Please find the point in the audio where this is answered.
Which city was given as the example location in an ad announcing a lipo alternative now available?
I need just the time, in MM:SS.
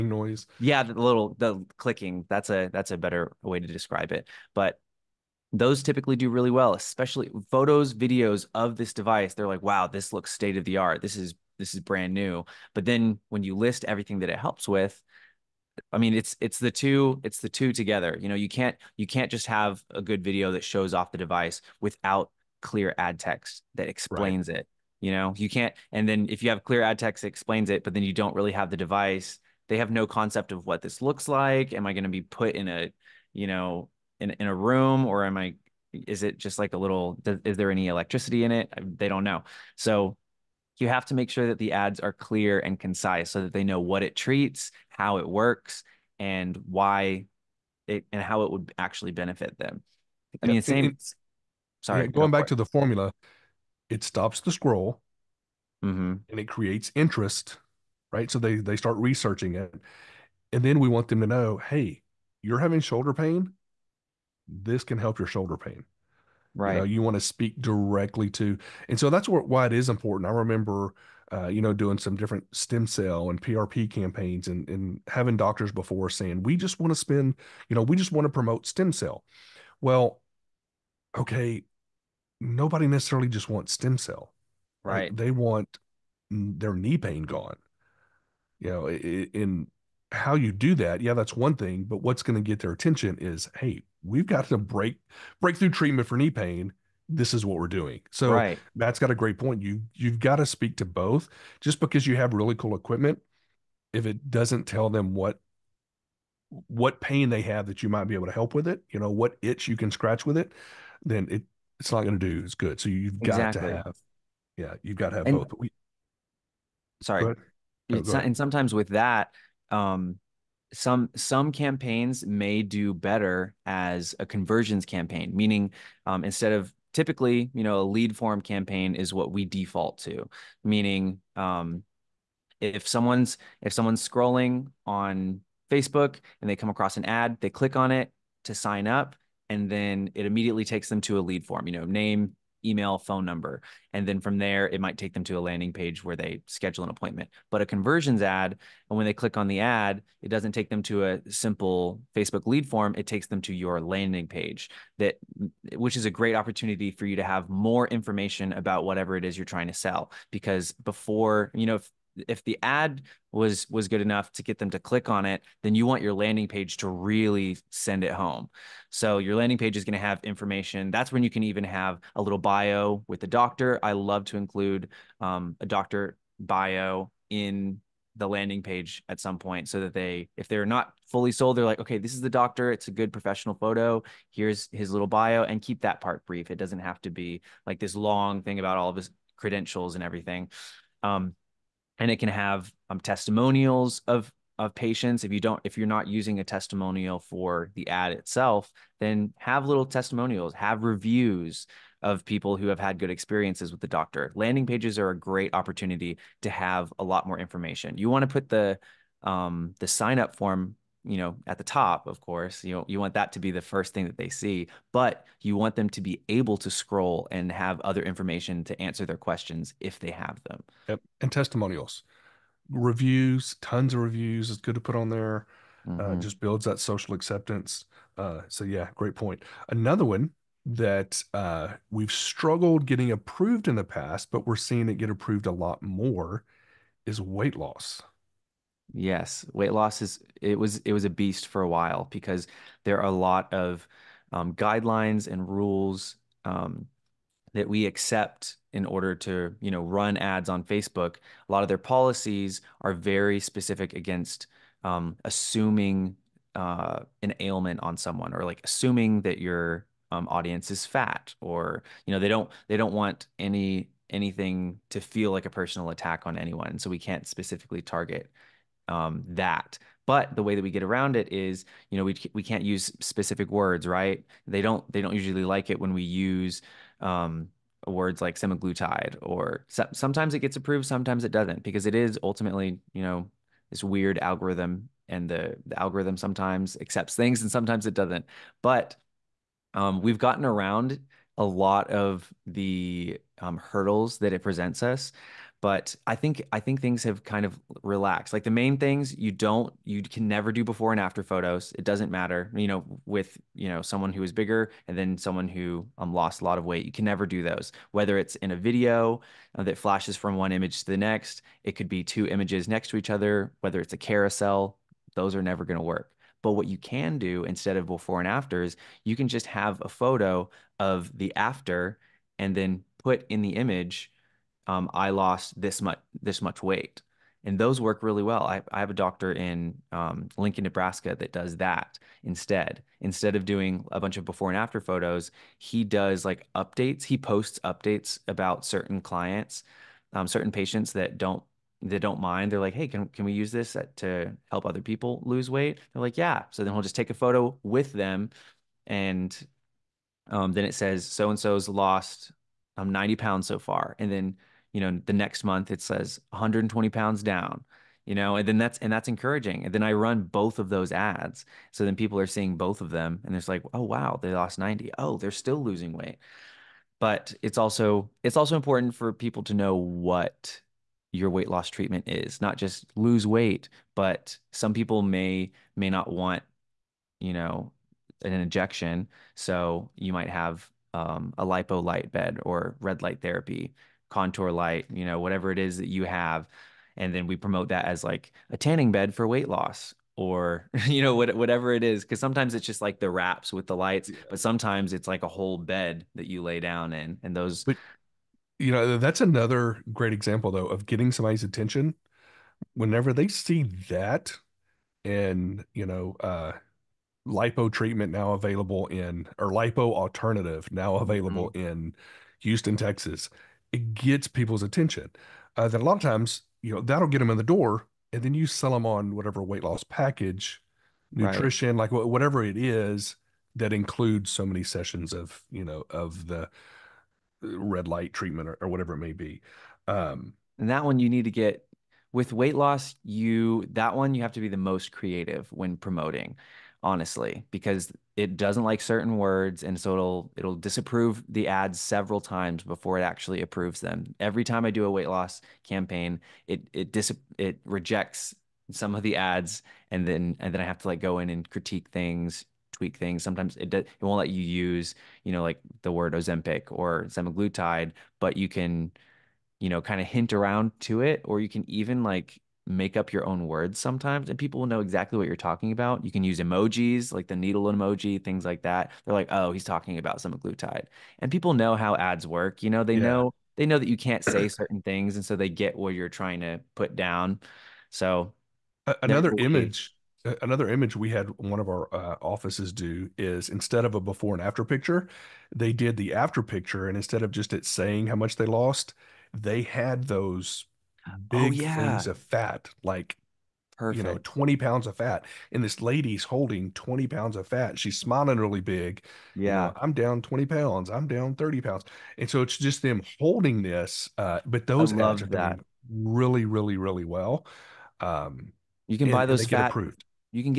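06:52.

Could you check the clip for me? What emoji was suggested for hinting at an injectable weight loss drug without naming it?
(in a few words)
needle emoji.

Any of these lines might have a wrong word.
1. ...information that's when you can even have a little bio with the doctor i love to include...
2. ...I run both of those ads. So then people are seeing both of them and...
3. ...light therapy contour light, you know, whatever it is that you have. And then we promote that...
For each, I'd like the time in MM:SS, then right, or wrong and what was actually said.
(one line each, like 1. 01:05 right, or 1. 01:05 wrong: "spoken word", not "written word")
1. 02:50 right
2. 05:59 right
3. 06:23 right.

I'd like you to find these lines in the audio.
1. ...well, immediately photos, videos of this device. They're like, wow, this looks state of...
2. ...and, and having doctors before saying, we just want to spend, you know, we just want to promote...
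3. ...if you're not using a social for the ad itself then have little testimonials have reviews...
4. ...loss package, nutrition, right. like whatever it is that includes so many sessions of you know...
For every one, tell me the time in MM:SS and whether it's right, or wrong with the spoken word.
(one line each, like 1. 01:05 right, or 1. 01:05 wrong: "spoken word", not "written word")
1. 00:06 wrong: "especially", not "immediately"
2. 01:14 right
3. 03:15 wrong: "testimonial", not "social"
4. 06:59 right.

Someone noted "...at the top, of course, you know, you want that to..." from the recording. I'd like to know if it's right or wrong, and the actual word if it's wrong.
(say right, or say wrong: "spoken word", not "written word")
right.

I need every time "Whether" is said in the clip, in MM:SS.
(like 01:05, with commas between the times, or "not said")
05:07, 05:13.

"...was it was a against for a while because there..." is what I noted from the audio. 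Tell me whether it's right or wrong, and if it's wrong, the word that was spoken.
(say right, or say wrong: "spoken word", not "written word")
wrong: "beast", not "against".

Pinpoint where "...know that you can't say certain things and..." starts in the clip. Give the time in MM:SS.
07:53.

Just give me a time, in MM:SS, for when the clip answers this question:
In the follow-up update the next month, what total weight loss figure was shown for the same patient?
05:56.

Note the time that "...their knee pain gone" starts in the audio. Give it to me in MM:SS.
01:26.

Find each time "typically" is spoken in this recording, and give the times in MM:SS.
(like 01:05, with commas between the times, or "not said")
00:05, 02:06.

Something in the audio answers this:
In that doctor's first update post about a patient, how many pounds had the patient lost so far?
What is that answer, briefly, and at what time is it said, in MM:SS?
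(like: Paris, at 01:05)
90, at 05:52.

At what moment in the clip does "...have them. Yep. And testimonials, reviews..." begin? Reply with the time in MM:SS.
03:40.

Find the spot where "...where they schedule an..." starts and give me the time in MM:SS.
02:26.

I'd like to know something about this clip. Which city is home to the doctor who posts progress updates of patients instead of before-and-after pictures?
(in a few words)
Lincoln, Nebraska.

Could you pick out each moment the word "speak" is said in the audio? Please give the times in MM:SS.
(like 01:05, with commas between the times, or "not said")
01:07, 01:40.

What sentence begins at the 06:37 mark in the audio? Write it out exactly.
And those, but, you know, that's another great example though of getting somebody's attention.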